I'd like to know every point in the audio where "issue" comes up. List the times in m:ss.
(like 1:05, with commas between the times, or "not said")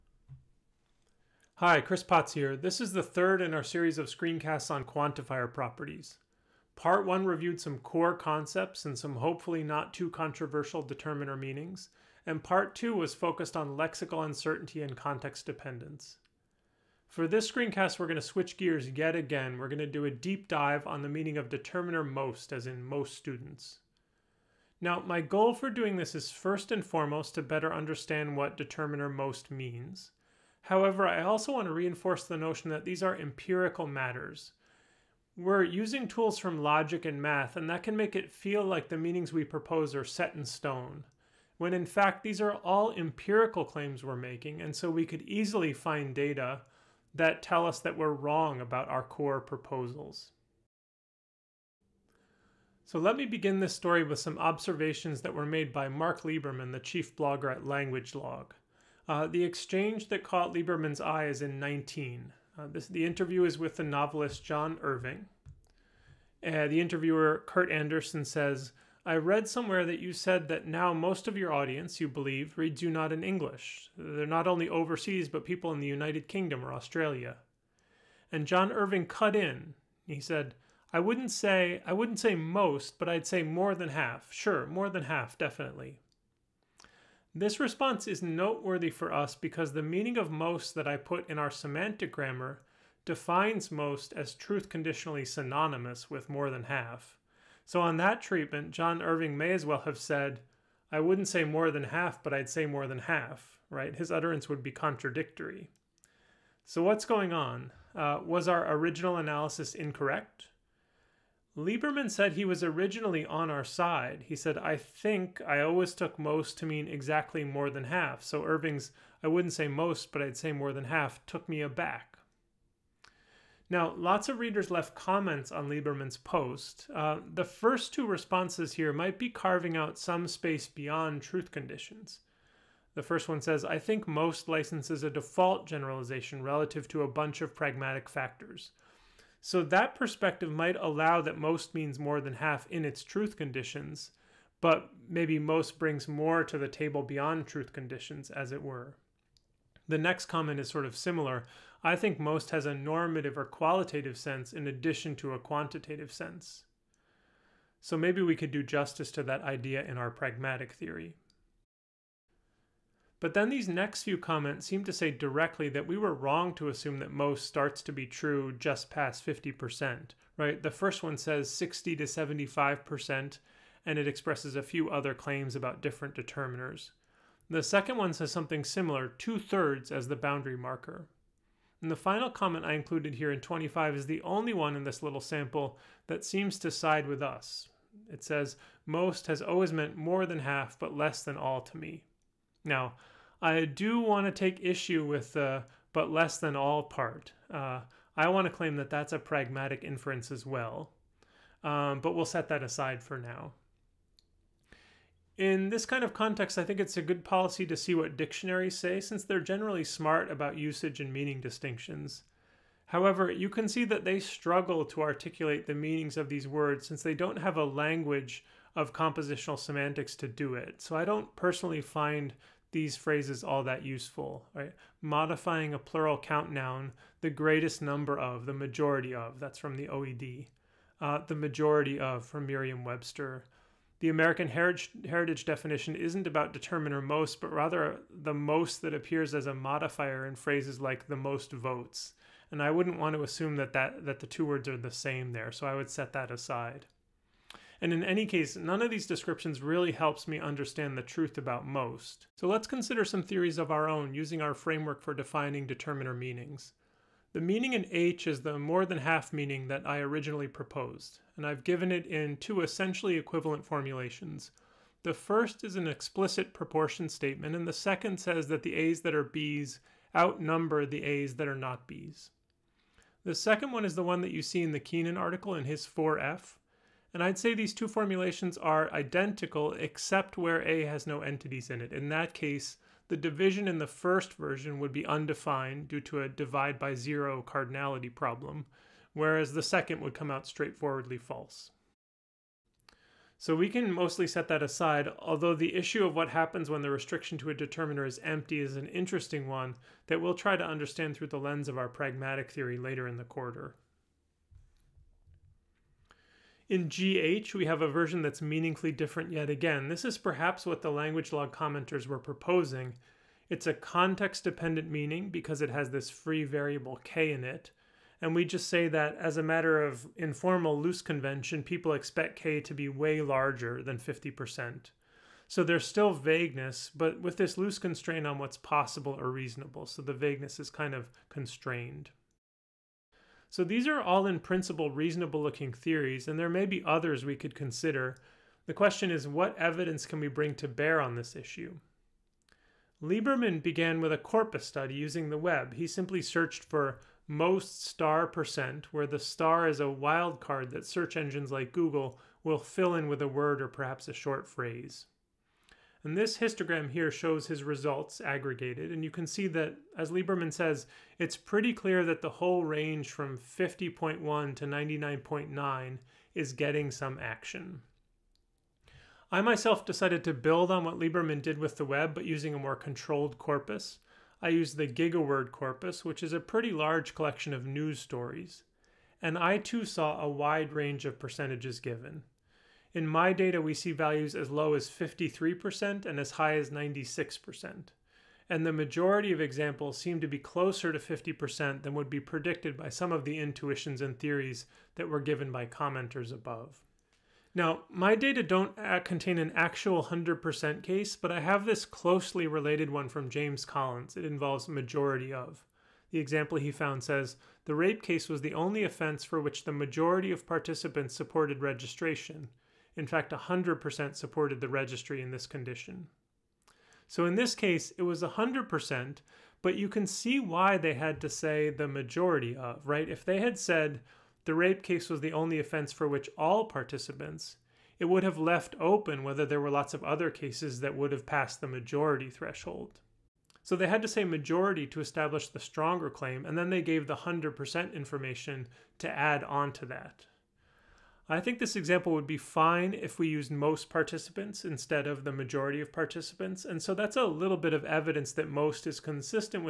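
3:14, 4:55, 5:41.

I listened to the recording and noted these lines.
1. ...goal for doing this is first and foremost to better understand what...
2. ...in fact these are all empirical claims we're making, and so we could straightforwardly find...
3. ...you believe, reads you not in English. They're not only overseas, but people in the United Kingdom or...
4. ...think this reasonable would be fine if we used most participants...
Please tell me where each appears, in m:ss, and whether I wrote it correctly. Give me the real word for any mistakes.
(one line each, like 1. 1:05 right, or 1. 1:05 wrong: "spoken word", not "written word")
1. 0:25 right
2. 0:41 wrong: "easily", not "straightforwardly"
3. 1:11 right
4. 7:21 wrong: "example", not "reasonable".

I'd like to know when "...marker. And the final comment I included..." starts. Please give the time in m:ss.
3:00.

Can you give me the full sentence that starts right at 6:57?
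So in this case, it was 100%, but you can see why they had to say the majority of, right?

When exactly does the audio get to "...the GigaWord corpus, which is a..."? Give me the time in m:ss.
6:14.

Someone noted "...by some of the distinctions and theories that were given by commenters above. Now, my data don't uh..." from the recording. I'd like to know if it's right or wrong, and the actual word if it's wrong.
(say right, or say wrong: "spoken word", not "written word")
wrong: "intuitions", not "distinctions".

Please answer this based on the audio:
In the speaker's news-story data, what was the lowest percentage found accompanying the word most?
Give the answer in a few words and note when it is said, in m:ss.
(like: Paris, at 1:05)
53%, at 6:24.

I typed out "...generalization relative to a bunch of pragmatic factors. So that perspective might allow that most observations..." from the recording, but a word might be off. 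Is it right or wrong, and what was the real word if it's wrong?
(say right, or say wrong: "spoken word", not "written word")
wrong: "means", not "observations".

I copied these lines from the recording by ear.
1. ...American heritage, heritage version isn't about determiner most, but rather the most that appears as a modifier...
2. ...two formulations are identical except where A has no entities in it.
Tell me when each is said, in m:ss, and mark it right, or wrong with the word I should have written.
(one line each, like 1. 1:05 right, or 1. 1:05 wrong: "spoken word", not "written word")
1. 3:54 wrong: "definition", not "version"
2. 4:37 right.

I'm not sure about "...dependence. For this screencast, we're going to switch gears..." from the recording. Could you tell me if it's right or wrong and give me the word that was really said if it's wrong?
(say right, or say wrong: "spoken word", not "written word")
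right.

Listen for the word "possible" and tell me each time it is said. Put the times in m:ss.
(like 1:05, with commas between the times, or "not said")
5:28.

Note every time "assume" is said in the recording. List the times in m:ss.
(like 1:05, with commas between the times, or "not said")
2:46, 4:03.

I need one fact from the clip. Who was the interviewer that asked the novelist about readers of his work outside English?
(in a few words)
Kurt Andersen.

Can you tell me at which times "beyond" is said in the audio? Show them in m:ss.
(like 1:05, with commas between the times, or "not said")
2:10, 2:27.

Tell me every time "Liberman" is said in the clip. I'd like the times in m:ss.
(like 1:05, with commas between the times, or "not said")
0:56, 1:00, 1:51, 2:05, 5:43, 6:00, 6:10.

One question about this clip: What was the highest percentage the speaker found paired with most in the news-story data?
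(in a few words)
96%.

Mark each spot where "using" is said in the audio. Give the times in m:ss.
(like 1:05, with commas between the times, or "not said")
0:35, 4:14, 5:44, 6:12.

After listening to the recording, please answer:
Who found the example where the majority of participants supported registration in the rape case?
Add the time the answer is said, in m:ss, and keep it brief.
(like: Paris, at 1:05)
James Collins, at 6:43.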